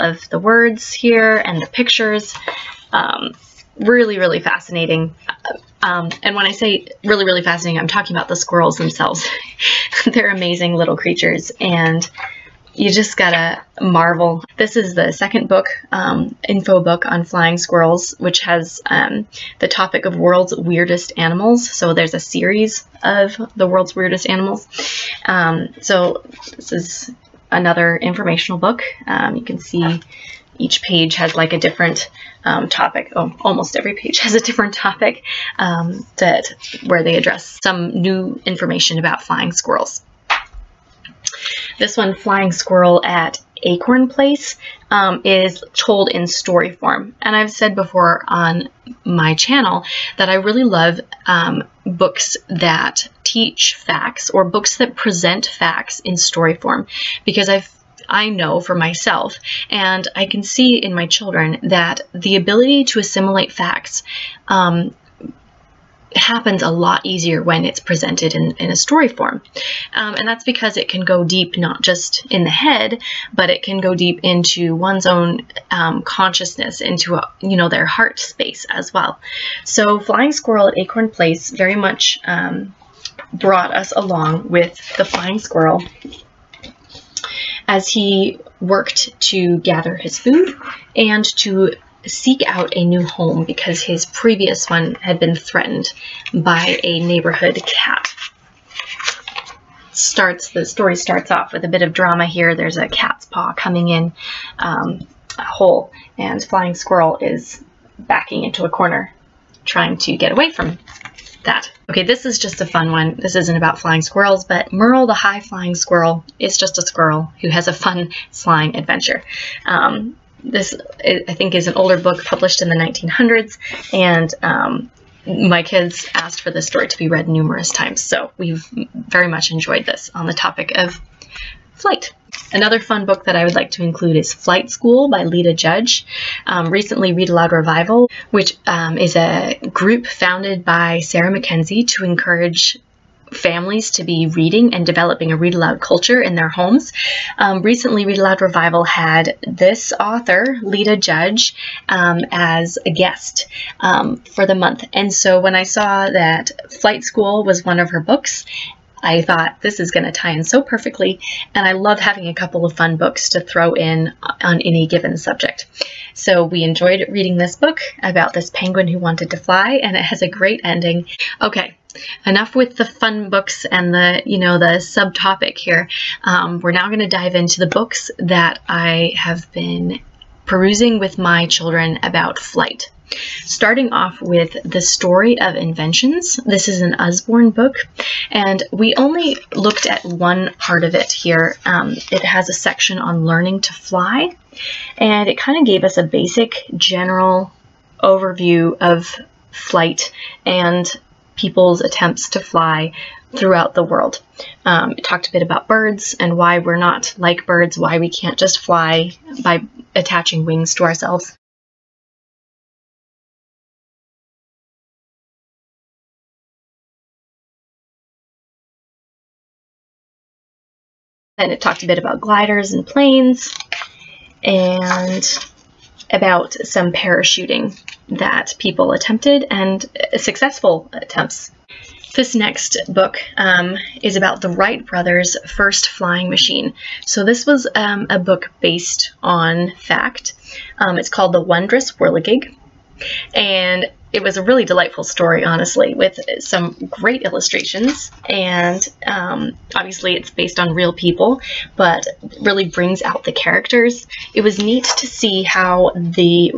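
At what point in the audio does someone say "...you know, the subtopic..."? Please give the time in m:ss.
2:54.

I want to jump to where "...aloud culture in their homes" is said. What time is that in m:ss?
2:25.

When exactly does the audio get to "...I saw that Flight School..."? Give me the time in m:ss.
2:35.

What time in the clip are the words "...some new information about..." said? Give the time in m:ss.
0:37.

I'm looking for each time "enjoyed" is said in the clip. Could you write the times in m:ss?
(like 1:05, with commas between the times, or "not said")
2:09, 2:46.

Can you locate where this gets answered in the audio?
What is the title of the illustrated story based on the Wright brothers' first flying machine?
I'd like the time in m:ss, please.
4:01.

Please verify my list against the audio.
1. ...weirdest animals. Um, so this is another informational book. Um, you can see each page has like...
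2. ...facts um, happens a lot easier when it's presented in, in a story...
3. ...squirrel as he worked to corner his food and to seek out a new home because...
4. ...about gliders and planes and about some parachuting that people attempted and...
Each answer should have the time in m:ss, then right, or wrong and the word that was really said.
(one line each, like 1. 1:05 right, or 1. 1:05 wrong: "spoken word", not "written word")
1. 0:23 right
2. 1:03 right
3. 1:25 wrong: "gather", not "corner"
4. 3:41 right.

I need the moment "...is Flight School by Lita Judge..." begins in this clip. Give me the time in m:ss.
2:14.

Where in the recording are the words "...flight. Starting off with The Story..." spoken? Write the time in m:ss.
3:02.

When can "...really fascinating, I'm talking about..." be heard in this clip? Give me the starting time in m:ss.
0:07.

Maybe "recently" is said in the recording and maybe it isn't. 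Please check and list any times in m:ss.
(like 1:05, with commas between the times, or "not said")
2:16, 2:27.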